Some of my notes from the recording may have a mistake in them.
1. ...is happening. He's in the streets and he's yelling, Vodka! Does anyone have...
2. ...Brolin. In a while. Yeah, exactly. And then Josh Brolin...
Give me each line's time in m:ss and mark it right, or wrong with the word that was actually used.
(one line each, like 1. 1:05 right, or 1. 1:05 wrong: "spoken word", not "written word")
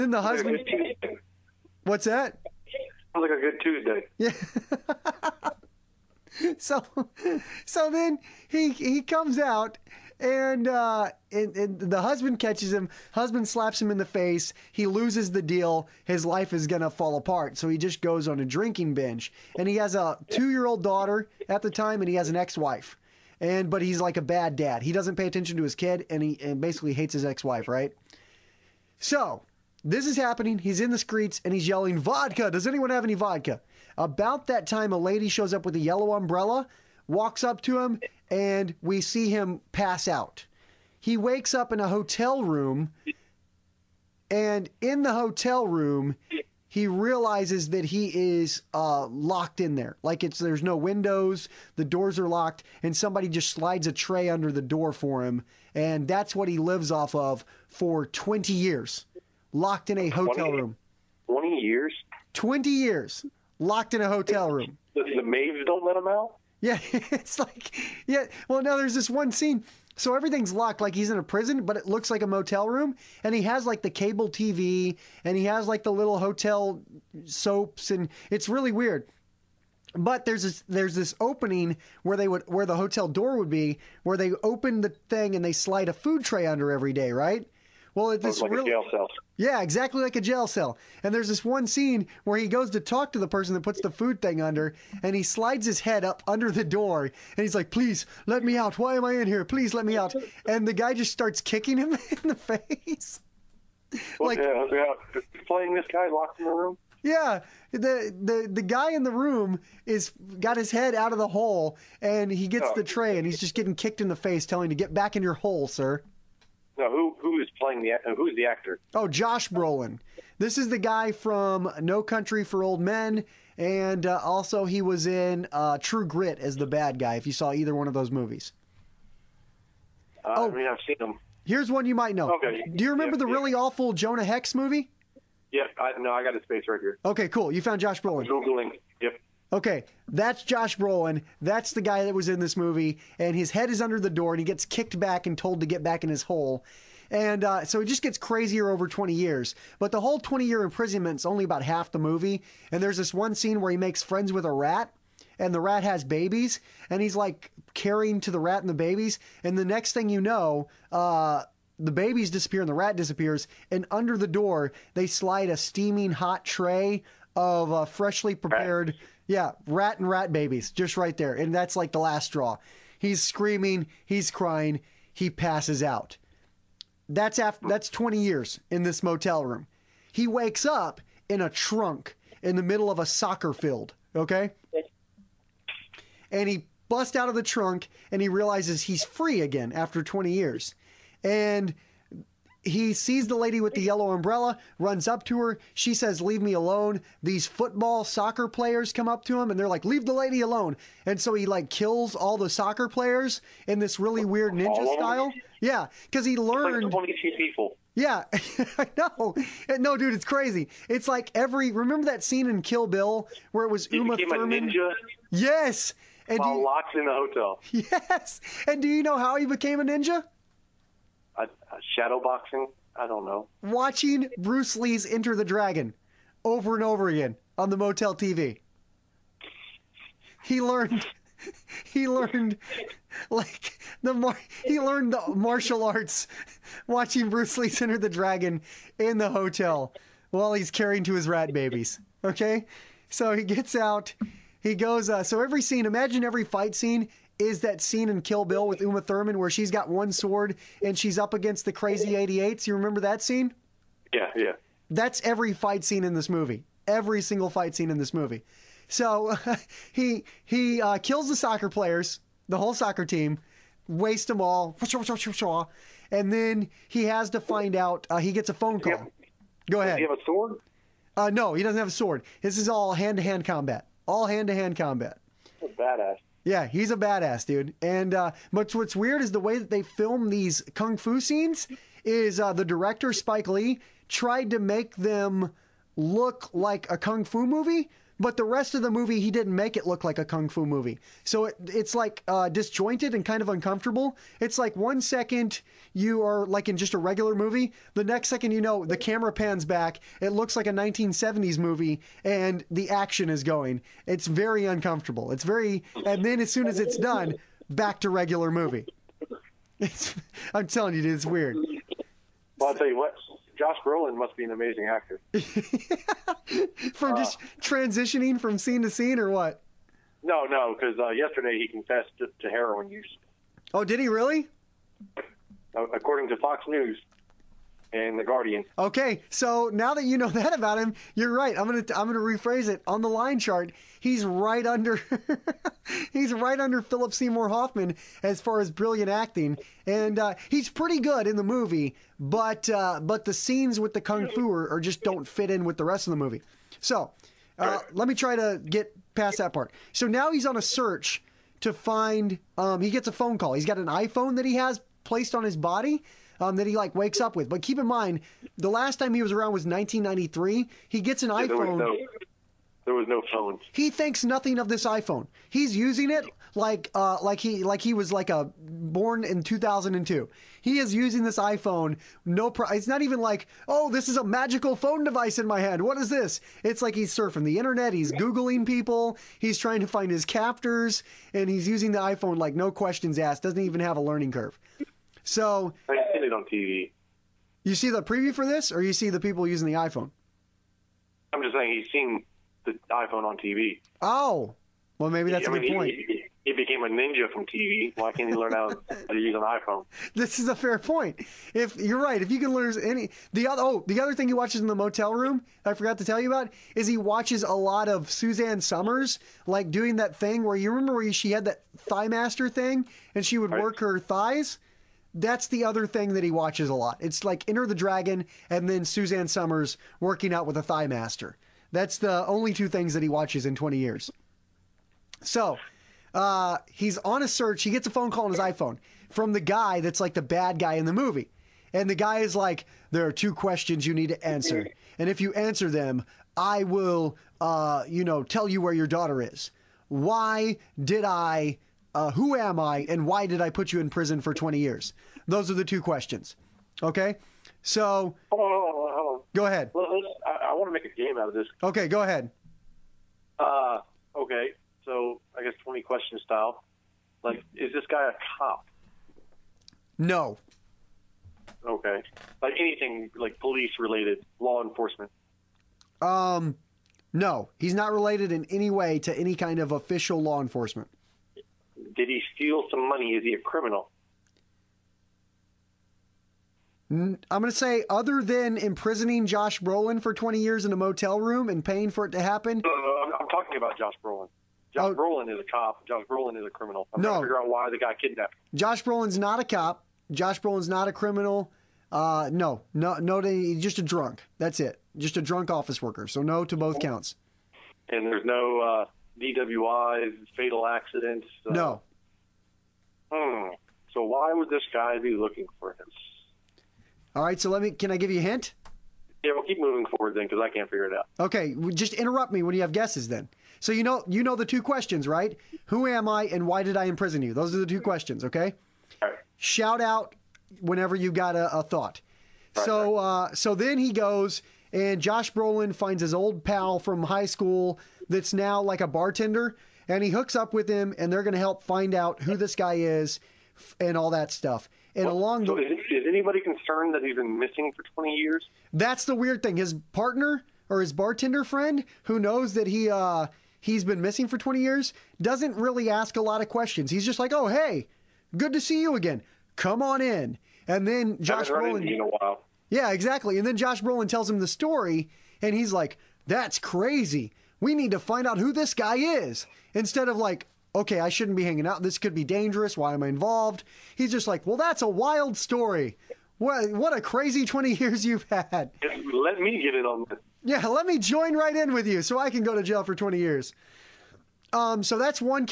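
1. 0:30 right
2. 9:11 right.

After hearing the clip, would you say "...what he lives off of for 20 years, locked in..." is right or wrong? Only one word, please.
right.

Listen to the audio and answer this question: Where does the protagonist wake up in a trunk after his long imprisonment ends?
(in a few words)
A soccer field.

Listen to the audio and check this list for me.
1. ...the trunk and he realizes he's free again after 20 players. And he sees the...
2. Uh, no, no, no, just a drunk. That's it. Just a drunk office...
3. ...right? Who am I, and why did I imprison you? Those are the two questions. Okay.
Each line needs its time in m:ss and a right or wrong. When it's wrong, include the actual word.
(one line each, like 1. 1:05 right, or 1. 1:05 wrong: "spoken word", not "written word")
1. 3:07 wrong: "years", not "players"
2. 8:11 right
3. 8:35 right.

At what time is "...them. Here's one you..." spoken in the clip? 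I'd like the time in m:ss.
2:10.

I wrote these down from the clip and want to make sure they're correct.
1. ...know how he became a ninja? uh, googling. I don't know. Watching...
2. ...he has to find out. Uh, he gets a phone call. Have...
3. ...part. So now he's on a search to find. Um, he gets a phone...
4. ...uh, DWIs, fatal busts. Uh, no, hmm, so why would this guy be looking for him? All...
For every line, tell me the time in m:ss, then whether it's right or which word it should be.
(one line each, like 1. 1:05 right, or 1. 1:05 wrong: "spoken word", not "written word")
1. 3:39 wrong: "shadowboxing", not "googling"
2. 4:26 right
3. 5:49 right
4. 8:18 wrong: "accidents", not "busts".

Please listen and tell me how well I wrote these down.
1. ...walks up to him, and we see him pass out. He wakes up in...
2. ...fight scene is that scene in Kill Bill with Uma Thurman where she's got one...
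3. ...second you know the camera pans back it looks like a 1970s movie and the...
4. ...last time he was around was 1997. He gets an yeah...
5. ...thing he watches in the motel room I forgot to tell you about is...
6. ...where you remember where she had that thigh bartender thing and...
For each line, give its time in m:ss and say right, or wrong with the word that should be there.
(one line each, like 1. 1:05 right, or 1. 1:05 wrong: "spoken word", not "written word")
1. 0:37 right
2. 4:06 right
3. 4:58 right
4. 5:58 wrong: "1993", not "1997"
5. 6:44 right
6. 6:50 wrong: "master", not "bartender".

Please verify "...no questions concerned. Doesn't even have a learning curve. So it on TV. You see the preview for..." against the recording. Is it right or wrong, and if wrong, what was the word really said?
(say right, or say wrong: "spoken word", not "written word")
wrong: "asked", not "concerned".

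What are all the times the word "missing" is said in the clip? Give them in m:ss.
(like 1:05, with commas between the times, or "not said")
8:57, 9:04.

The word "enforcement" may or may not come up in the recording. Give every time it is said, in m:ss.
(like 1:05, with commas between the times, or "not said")
7:44, 7:50.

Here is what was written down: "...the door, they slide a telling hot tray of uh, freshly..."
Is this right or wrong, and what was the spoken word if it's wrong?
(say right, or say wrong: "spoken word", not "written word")
wrong: "steaming", not "telling".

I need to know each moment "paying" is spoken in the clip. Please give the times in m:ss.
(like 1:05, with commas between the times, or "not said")
8:01.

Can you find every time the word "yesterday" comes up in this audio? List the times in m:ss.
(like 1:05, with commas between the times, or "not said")
5:21.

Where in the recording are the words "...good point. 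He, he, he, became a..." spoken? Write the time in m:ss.
6:35.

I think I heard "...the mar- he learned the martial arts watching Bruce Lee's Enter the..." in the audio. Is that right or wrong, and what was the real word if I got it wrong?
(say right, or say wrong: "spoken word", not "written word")
right.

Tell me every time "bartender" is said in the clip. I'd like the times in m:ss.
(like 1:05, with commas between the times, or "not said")
8:48, 9:00.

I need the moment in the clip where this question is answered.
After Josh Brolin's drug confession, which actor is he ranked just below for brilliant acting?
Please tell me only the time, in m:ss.
5:36.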